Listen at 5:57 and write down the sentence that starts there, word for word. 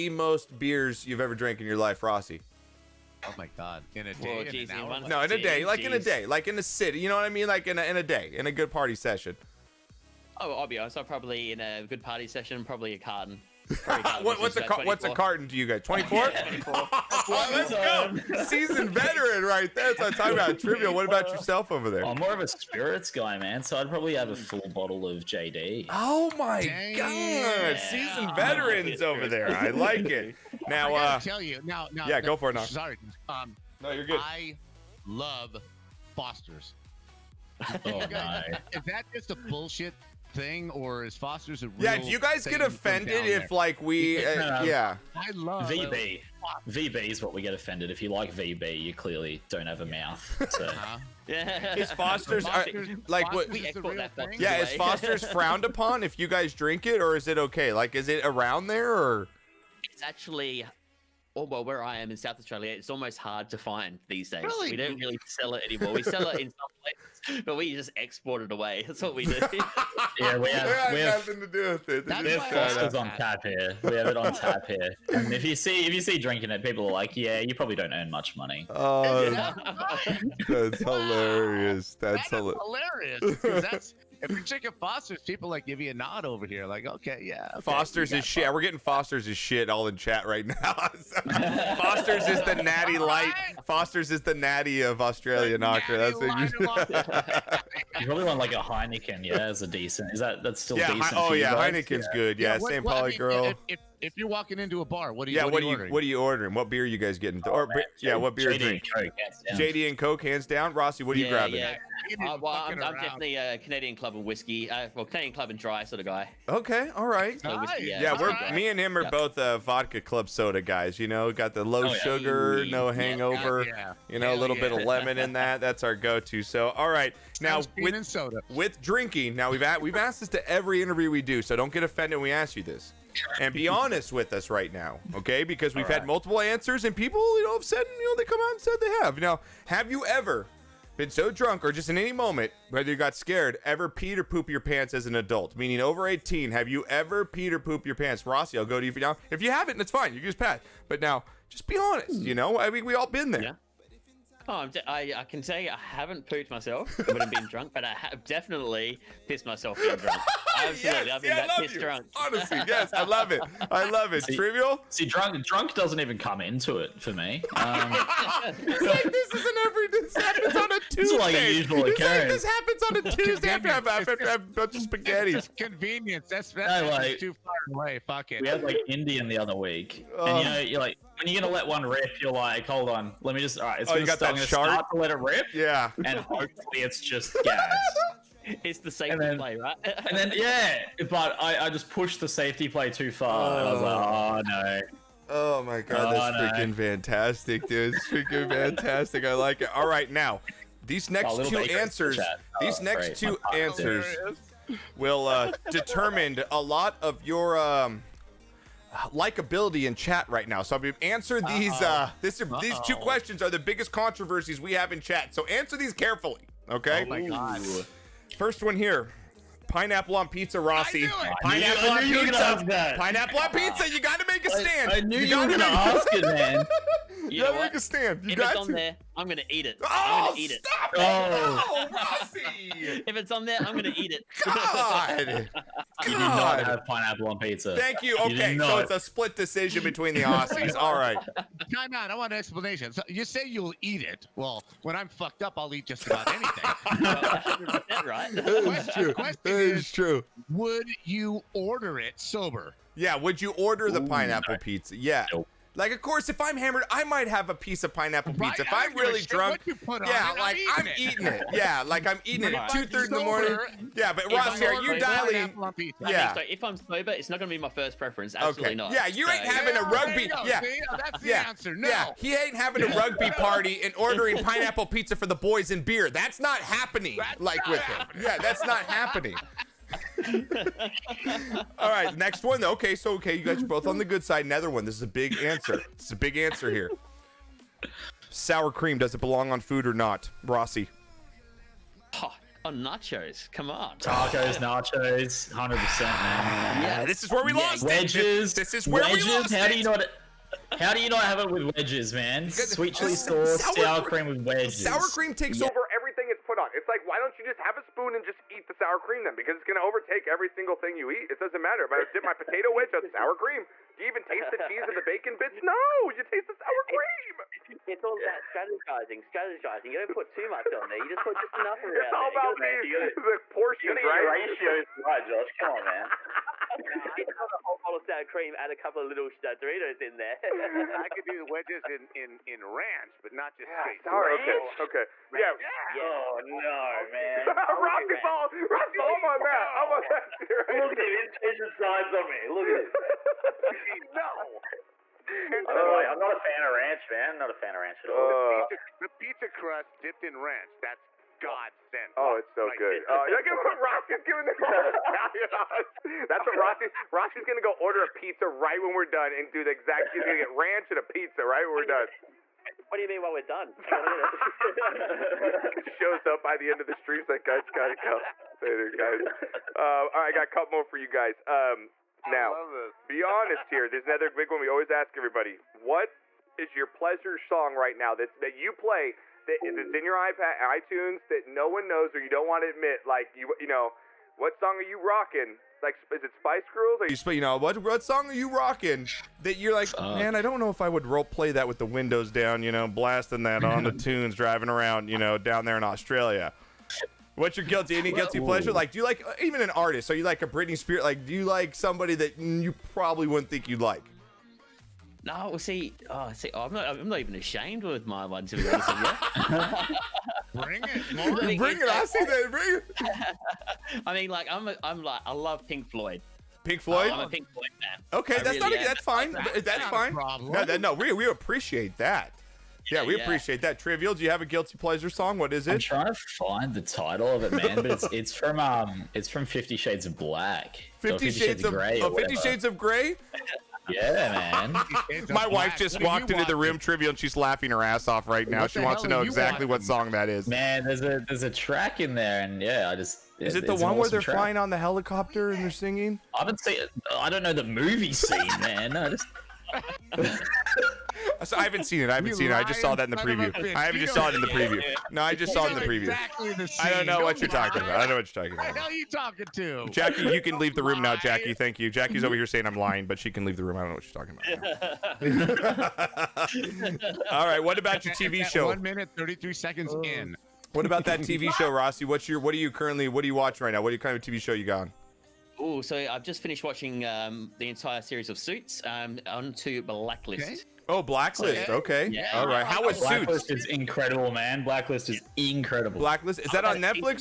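Rossi's gonna go order a pizza right when we're done and do the exact.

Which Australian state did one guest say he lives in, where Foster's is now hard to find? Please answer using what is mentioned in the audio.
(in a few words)
South Australia.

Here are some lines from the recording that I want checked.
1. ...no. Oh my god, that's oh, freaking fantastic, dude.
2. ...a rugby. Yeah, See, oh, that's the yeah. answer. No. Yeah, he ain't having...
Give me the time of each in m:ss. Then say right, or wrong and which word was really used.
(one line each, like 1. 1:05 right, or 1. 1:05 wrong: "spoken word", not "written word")
1. 3:14 right
2. 4:29 right.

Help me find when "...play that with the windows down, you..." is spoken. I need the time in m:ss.
6:31.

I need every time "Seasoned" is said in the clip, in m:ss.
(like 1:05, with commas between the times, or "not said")
0:18, 0:27.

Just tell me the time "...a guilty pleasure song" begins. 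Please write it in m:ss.
7:04.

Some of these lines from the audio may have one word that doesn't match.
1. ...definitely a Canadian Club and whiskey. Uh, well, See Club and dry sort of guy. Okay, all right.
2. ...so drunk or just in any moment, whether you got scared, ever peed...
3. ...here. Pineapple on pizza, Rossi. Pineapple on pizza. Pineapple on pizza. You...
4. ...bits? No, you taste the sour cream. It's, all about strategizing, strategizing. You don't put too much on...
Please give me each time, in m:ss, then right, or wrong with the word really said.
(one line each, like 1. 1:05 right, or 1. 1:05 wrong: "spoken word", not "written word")
1. 1:52 wrong: "Canadian", not "See"
2. 2:21 right
3. 3:38 right
4. 5:15 right.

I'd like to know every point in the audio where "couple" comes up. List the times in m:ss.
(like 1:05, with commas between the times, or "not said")
5:28, 6:10.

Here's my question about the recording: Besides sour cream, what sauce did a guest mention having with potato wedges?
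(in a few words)
Sweet chili sauce.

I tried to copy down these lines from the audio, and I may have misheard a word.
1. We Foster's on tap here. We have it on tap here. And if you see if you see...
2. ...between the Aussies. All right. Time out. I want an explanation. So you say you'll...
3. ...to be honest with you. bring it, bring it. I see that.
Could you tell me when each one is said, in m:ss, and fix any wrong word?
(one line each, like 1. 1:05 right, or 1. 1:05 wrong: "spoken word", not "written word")
1. 1:12 right
2. 3:59 right
3. 6:48 right.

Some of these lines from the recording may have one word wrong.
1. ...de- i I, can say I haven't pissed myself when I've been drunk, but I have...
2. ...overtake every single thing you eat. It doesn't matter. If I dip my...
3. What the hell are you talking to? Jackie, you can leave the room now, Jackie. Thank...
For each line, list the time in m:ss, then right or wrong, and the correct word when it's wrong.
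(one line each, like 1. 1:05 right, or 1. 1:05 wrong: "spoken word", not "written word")
1. 2:34 wrong: "pooped", not "pissed"
2. 5:09 right
3. 7:38 right.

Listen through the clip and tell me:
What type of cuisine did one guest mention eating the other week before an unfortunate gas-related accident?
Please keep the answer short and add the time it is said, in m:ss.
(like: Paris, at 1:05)
Indian, at 2:58.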